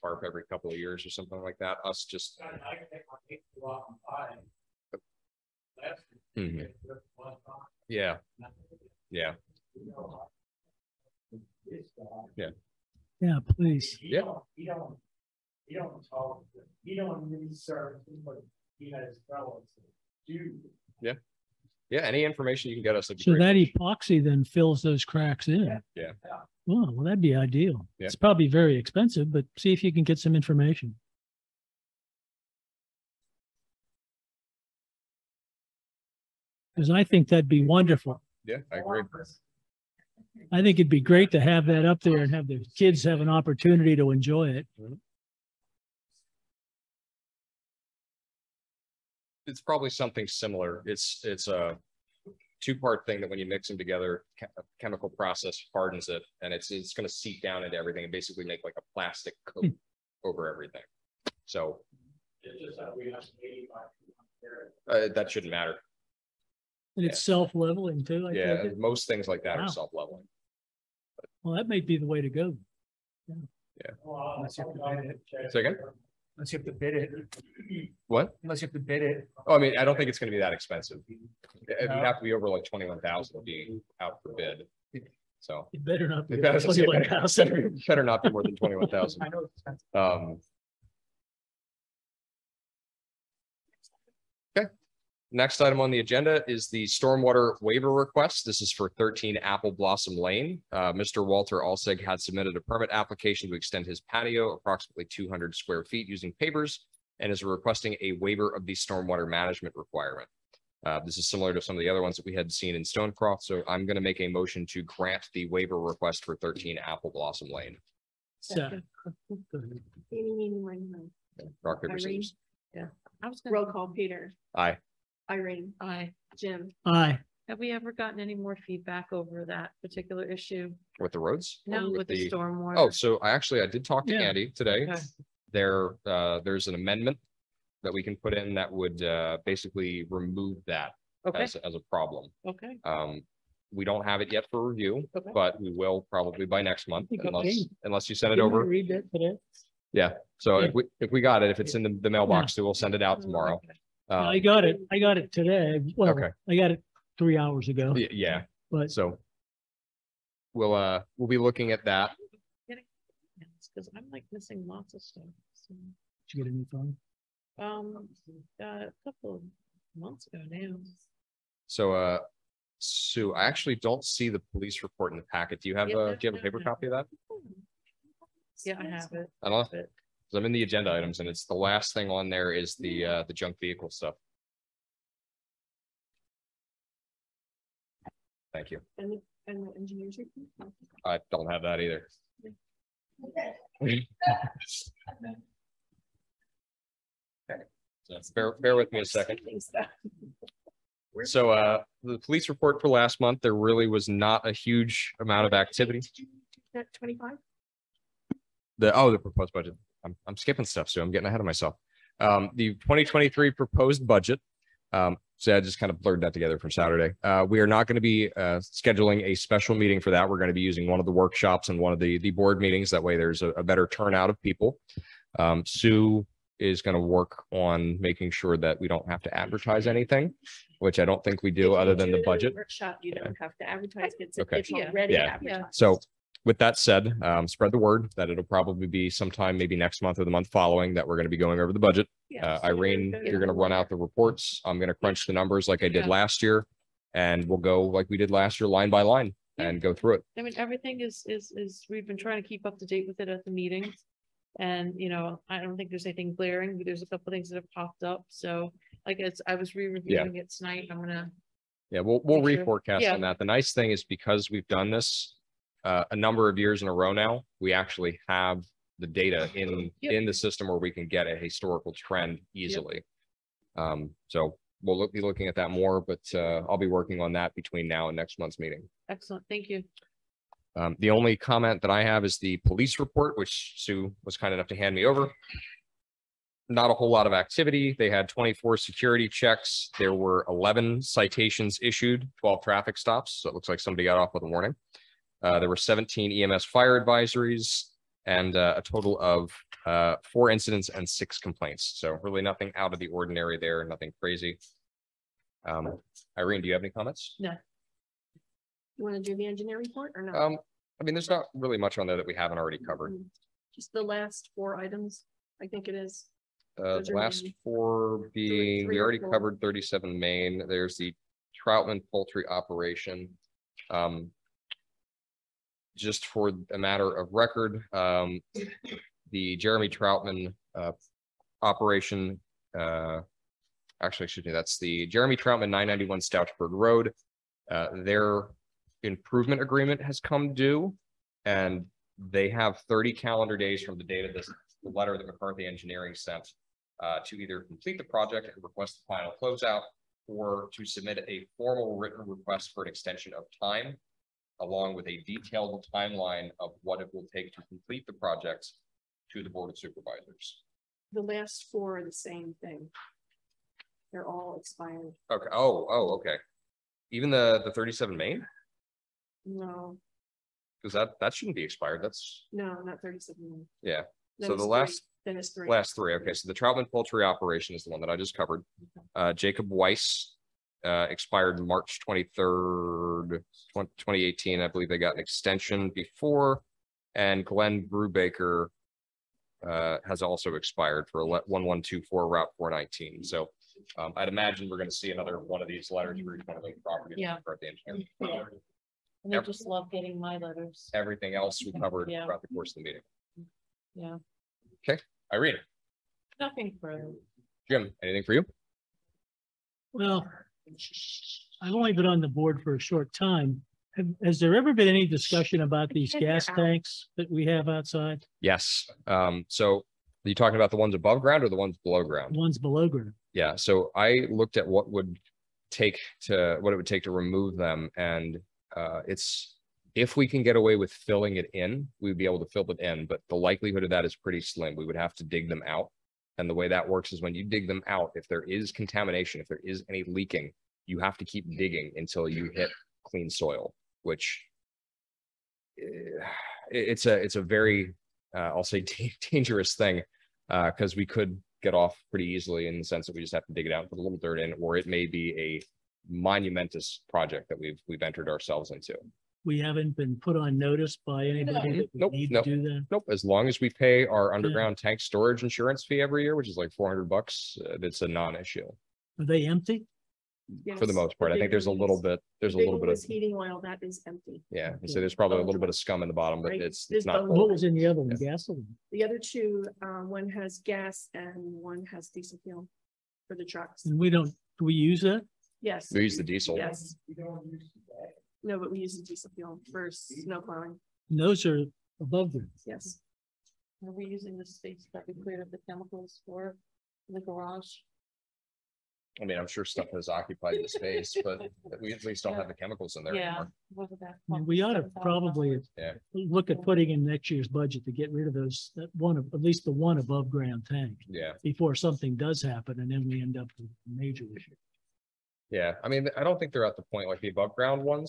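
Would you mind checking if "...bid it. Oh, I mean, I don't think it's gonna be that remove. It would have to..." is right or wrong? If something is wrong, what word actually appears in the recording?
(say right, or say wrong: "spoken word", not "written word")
wrong: "expensive", not "remove".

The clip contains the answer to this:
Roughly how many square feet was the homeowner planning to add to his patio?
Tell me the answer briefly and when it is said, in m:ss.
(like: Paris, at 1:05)
200, at 1:45.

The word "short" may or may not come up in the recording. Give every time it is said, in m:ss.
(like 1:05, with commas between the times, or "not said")
6:52.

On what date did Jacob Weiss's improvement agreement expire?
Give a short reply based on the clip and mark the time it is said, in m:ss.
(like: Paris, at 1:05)
March 23, 2018, at 6:21.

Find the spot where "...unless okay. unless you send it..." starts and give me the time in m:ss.
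2:27.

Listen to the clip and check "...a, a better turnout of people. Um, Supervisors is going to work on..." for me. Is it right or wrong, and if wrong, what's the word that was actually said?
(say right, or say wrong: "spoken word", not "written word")
wrong: "Sue", not "Supervisors".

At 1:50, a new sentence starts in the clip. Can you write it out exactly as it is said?
Uh, this is similar to some of the other ones that we had seen in Stonecroft.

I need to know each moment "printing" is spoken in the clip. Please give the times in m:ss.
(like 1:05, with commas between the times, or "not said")
not said.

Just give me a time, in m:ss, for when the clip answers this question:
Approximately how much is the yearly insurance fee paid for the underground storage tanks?
7:46.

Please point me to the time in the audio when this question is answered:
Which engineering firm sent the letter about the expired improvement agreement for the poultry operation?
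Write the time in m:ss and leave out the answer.
5:45.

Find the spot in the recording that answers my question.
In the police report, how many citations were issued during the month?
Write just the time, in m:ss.
4:50.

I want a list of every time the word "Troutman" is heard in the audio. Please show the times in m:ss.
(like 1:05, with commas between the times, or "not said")
5:21, 5:29, 5:35, 6:16.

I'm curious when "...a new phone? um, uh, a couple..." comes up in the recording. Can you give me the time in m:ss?
2:46.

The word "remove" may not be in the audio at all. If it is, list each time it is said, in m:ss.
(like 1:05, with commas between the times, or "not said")
2:20, 7:07.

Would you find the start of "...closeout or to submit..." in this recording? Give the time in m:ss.
5:49.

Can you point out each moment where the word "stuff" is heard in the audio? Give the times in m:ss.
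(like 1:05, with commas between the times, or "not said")
2:45, 3:03, 3:30, 8:19.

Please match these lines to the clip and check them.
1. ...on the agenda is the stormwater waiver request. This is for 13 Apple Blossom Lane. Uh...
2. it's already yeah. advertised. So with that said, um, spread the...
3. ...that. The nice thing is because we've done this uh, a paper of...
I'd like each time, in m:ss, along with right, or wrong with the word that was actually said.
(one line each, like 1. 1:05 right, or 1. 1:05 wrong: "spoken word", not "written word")
1. 1:35 right
2. 3:54 right
3. 4:23 wrong: "number", not "paper".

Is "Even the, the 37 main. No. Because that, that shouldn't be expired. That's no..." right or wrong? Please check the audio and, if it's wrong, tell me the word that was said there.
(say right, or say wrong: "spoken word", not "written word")
right.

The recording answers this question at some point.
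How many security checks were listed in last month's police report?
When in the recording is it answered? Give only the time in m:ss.
4:48.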